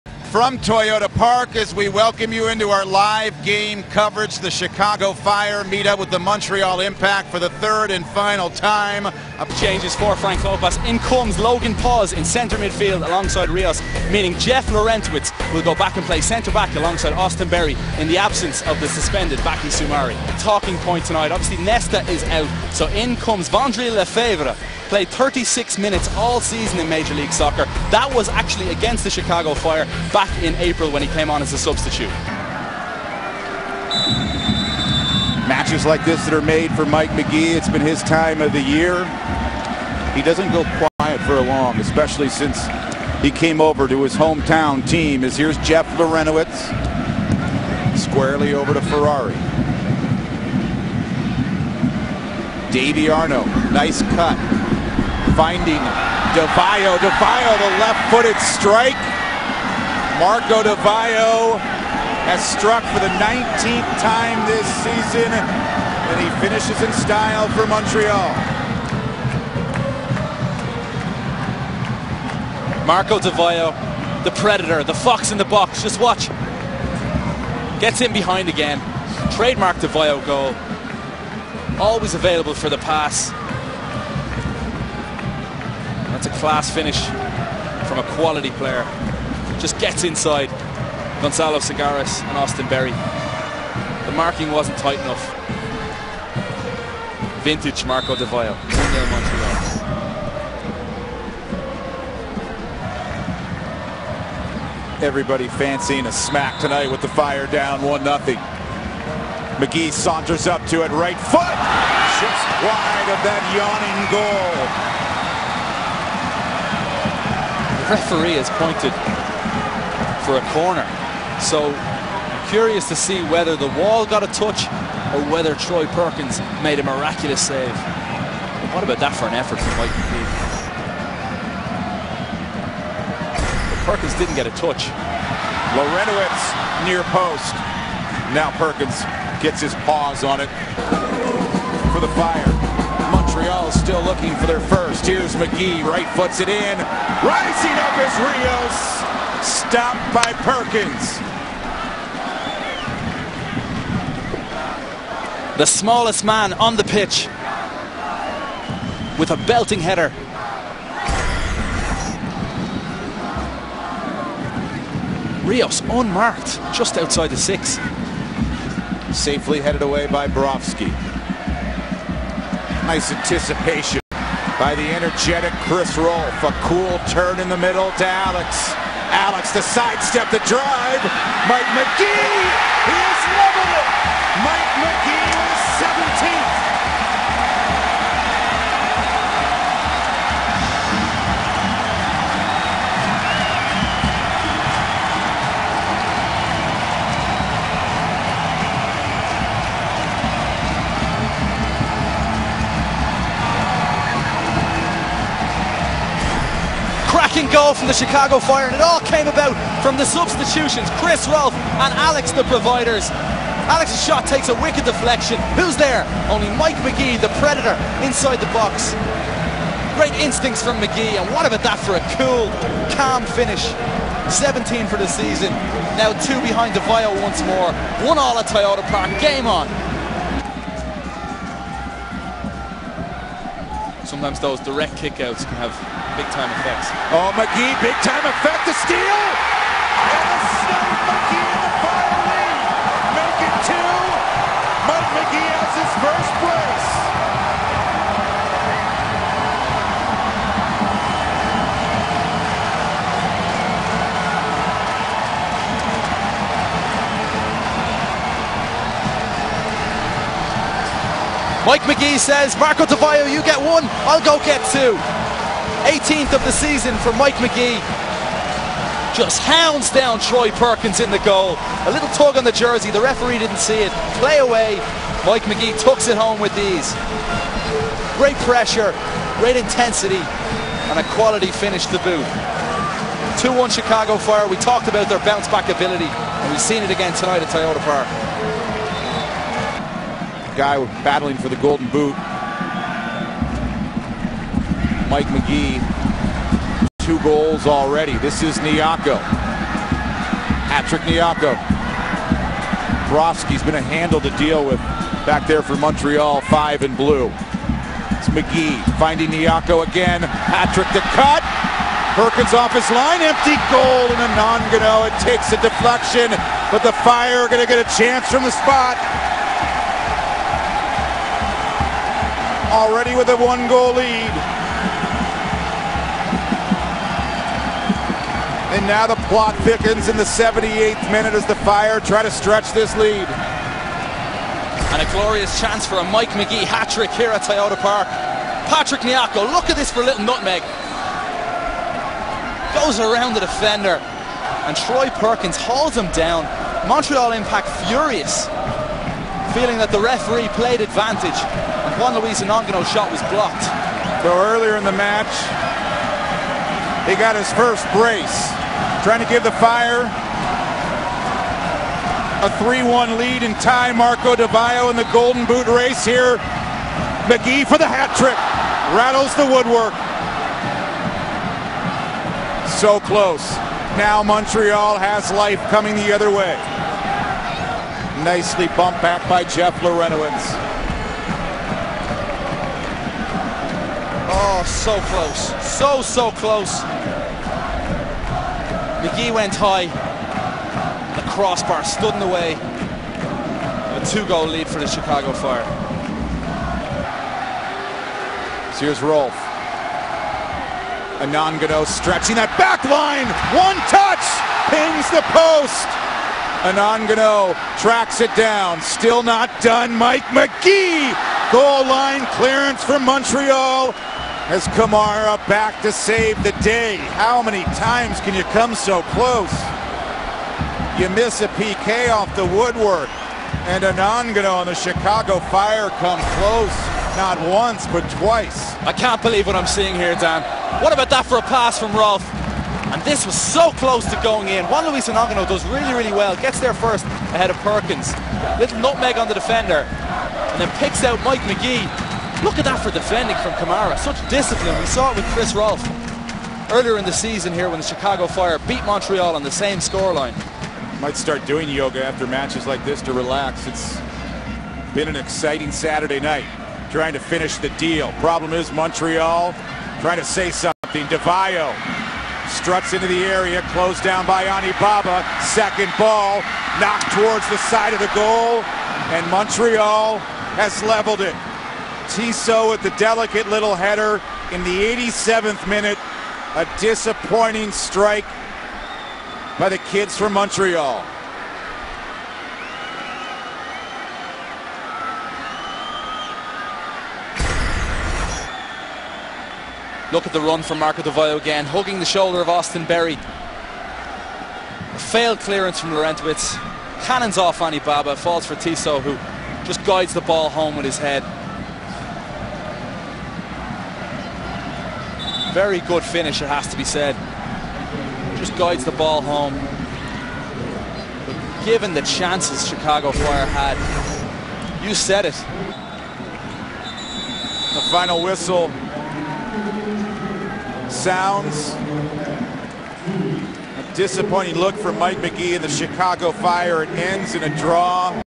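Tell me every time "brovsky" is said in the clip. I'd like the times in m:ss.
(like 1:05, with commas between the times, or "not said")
2:50, 5:03.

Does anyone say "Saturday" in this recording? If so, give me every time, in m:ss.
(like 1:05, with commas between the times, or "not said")
7:35.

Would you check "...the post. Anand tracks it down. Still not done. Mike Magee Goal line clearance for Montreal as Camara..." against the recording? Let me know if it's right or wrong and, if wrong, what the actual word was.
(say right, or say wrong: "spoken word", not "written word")
right.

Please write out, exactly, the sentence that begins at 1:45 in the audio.
everybody fancying a smack tonight with the fire down 1 nothing.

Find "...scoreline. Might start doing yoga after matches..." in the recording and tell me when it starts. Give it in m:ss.
7:29.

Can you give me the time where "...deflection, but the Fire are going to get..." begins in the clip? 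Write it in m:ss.
5:15.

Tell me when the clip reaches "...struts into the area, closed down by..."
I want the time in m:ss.
7:42.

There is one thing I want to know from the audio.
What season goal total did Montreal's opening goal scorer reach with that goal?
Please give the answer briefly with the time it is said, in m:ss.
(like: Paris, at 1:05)
19, at 1:03.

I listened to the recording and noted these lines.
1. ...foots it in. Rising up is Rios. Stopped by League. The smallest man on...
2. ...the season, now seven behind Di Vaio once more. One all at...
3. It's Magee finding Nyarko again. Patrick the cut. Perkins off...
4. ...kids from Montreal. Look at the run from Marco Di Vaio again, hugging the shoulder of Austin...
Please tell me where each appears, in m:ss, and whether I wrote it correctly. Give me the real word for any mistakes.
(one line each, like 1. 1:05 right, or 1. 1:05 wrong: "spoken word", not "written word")
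1. 2:26 wrong: "Perkins", not "League"
2. 3:44 wrong: "two", not "seven"
3. 5:08 right
4. 7:59 right.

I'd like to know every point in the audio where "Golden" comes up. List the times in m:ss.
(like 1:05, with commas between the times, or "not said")
4:51, 6:05.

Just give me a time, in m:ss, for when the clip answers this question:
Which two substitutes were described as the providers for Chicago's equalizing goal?
3:31.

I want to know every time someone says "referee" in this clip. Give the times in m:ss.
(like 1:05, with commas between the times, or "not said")
1:57, 4:32, 5:49.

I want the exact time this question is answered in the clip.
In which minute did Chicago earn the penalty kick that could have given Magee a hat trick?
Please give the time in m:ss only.
5:30.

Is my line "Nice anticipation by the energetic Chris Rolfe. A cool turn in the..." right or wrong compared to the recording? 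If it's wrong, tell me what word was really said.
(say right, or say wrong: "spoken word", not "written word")
right.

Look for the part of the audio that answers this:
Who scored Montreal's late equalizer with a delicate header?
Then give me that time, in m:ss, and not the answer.
7:52.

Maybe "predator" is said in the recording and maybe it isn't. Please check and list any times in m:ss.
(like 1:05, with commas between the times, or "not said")
1:14, 3:37.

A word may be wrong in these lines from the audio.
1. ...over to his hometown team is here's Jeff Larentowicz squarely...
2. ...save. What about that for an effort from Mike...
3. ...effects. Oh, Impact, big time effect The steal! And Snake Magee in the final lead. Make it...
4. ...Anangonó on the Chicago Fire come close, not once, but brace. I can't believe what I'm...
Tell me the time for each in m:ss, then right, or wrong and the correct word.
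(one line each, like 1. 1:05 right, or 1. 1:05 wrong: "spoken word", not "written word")
1. 0:43 right
2. 2:07 right
3. 3:56 wrong: "Magee", not "Impact"
4. 7:03 wrong: "twice", not "brace".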